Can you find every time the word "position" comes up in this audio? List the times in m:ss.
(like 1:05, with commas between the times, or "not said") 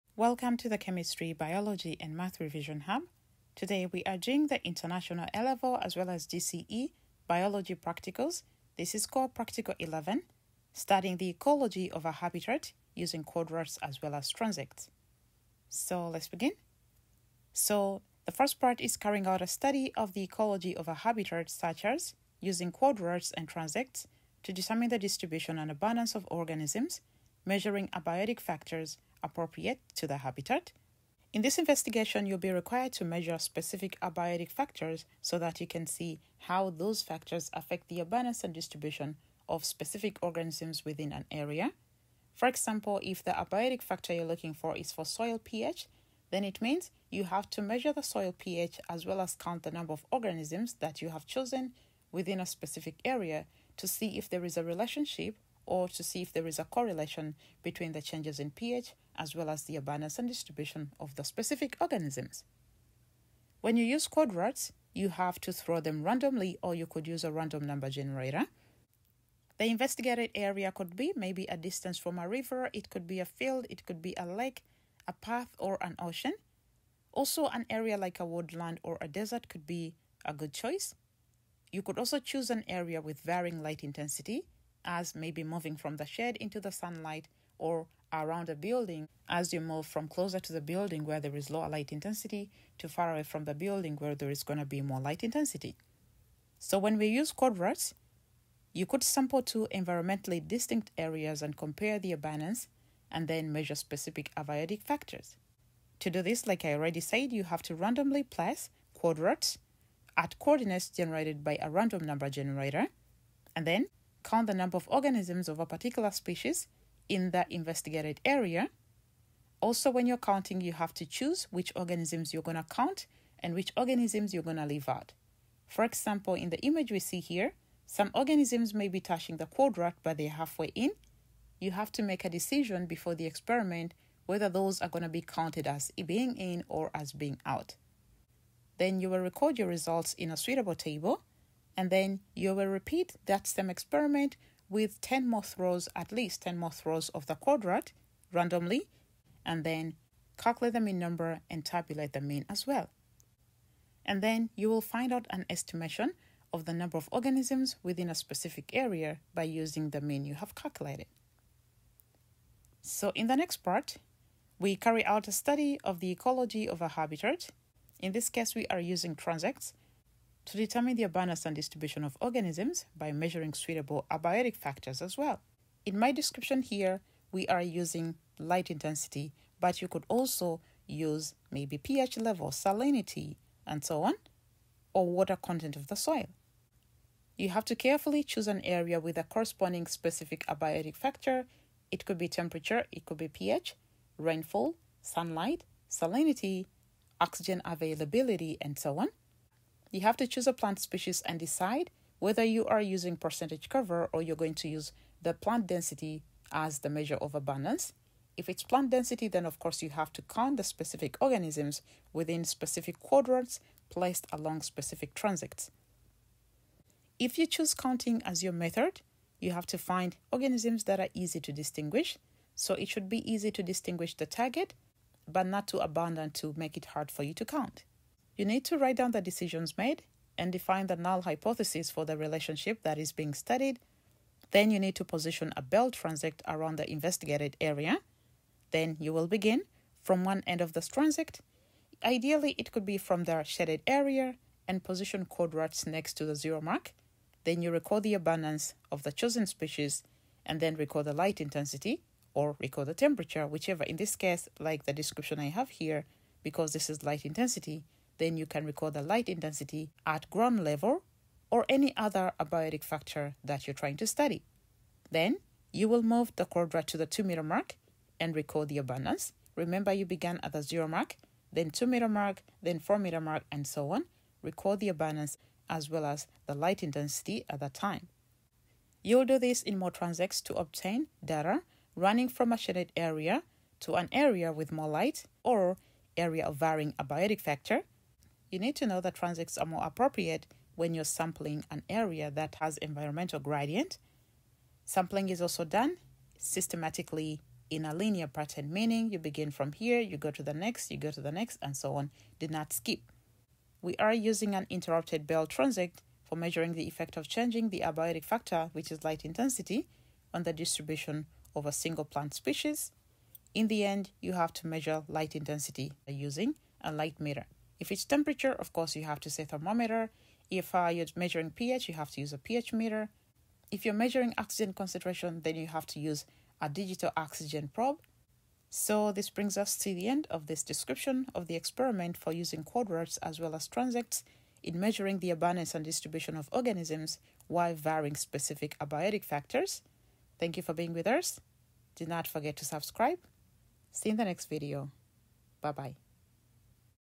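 3:55, 4:04.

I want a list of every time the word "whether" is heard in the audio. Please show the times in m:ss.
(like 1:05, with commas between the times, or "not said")
2:14, 3:22.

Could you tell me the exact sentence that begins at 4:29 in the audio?
Remember, you began at the 0 mark, then 2 meter mark, then 4 meter mark, and so on.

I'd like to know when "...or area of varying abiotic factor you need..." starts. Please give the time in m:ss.
4:45.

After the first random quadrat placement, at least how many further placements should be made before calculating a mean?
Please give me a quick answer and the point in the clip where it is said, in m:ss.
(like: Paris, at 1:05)
10, at 2:25.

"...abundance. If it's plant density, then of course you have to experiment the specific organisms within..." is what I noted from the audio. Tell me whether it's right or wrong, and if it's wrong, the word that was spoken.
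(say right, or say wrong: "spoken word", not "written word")
wrong: "count", not "experiment".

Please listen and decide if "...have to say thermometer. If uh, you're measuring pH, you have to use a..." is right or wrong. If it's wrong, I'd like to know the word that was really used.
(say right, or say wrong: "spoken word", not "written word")
right.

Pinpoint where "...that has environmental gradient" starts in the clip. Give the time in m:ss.
4:52.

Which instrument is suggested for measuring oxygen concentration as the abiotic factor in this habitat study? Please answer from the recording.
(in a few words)
Digital oxygen probe.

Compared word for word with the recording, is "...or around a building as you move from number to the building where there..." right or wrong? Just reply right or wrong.
wrong.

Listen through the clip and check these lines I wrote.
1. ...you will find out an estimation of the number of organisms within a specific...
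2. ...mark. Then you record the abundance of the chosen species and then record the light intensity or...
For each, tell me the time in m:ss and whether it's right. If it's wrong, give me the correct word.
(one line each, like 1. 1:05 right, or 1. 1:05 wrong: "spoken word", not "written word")
1. 2:34 right
2. 4:06 right.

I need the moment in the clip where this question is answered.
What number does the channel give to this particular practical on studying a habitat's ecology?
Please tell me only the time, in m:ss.
0:09.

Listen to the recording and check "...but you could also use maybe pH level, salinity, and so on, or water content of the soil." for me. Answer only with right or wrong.
right.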